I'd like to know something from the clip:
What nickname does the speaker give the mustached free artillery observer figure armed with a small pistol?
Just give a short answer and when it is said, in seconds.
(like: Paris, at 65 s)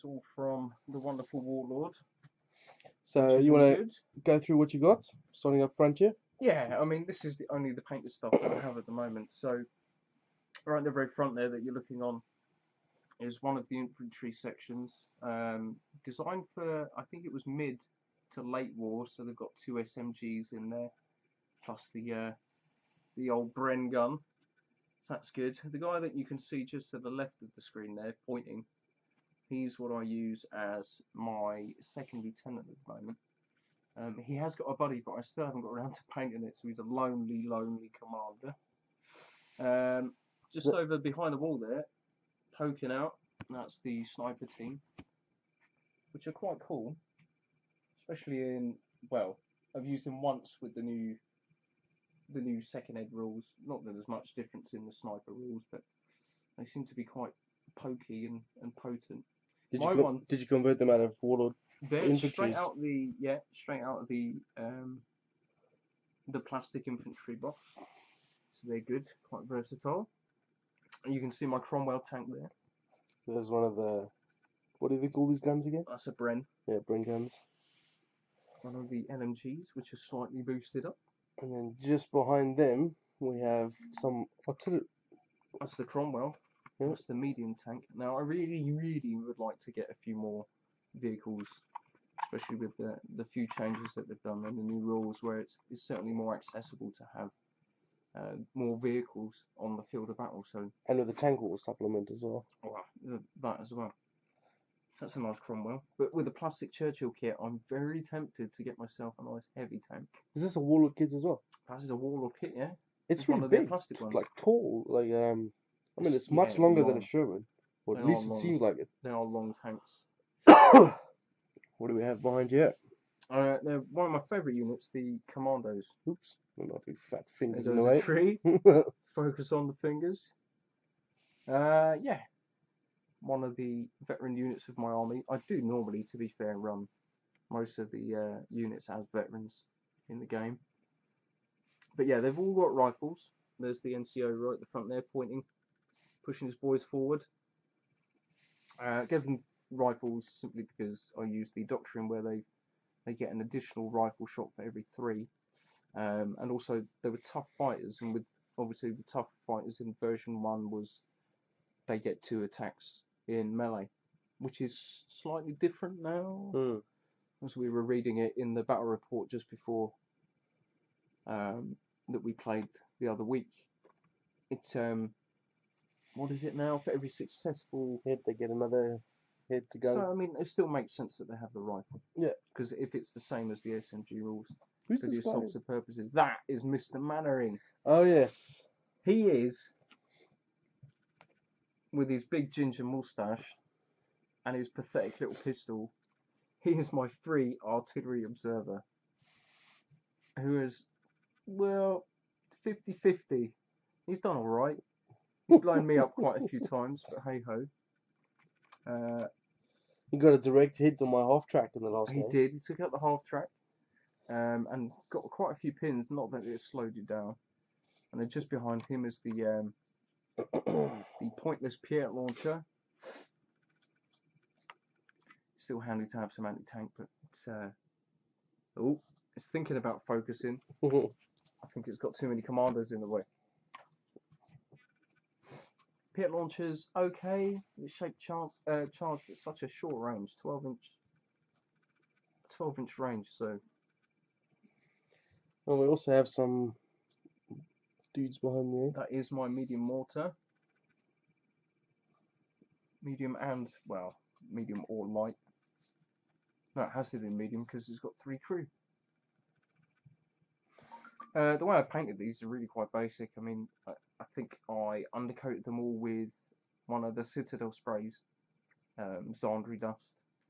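Mr. Mainwaring, at 186 s.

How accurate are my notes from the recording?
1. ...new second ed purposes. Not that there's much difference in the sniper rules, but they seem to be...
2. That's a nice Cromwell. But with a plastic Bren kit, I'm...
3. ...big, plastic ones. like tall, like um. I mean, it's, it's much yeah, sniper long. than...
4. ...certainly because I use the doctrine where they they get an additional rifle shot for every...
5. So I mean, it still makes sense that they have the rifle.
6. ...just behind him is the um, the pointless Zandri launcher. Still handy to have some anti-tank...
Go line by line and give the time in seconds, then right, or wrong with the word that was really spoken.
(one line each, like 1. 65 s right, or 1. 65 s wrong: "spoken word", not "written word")
1. 52 s wrong: "rules", not "purposes"
2. 105 s wrong: "Churchill", not "Bren"
3. 113 s wrong: "longer", not "sniper"
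4. 150 s wrong: "simply", not "certainly"
5. 179 s right
6. 218 s wrong: "PIAT", not "Zandri".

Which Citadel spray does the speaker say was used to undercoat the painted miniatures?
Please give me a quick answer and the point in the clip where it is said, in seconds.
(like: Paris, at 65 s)
Zandri Dust, at 269 s.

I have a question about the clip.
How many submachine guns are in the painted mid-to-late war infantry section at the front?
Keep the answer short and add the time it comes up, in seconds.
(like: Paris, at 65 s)
2, at 19 s.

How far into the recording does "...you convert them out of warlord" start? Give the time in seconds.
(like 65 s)
60 s.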